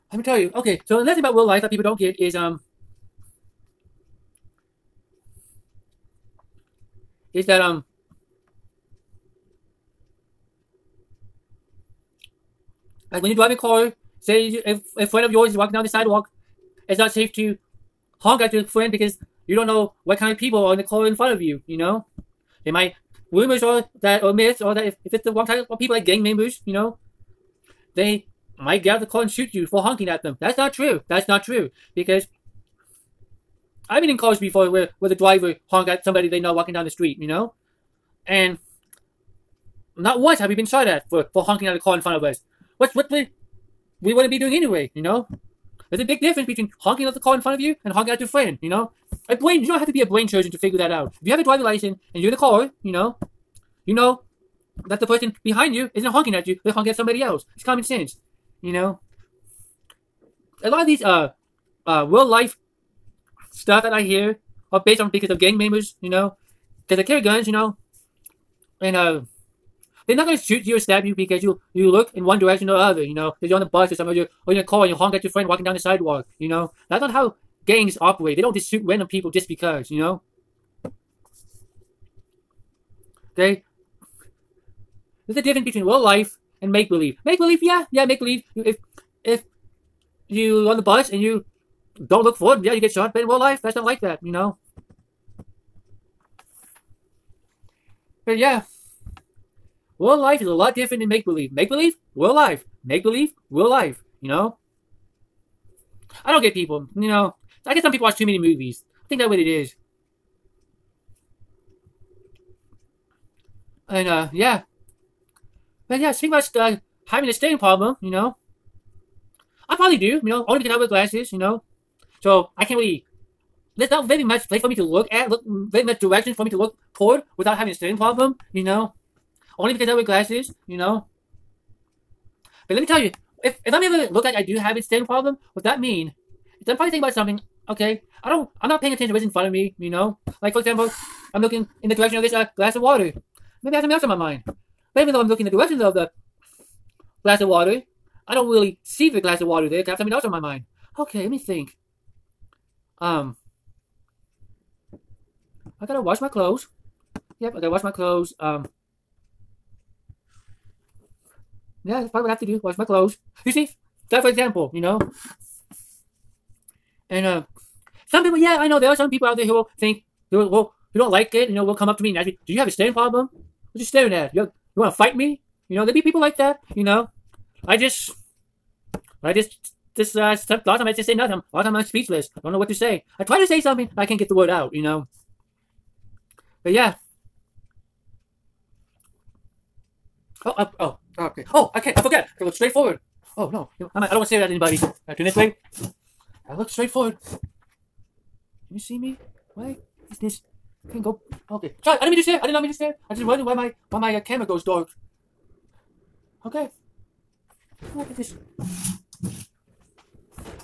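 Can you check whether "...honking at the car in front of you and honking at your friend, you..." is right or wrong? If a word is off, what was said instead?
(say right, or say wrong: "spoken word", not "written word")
right.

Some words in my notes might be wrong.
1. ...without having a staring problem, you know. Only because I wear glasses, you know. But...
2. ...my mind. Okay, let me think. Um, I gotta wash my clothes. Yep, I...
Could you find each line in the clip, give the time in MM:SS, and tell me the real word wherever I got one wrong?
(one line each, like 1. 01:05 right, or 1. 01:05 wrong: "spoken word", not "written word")
1. 02:07 right
2. 02:30 right.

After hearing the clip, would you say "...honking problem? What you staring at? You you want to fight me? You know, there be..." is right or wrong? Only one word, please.
wrong.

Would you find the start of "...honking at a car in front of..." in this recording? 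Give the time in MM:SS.
00:41.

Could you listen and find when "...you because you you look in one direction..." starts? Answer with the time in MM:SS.
01:11.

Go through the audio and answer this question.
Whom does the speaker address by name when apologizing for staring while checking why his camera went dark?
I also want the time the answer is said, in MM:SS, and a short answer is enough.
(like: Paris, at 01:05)
Charlie, at 03:21.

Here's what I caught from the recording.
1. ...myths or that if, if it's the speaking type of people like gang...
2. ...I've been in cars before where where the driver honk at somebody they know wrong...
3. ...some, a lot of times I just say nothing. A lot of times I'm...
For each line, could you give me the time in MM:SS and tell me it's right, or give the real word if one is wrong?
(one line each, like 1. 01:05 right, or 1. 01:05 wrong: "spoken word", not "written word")
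1. 00:24 wrong: "wrong", not "speaking"
2. 00:33 wrong: "walking", not "wrong"
3. 03:00 right.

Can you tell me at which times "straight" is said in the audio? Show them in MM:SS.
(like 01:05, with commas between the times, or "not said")
03:12, 03:16.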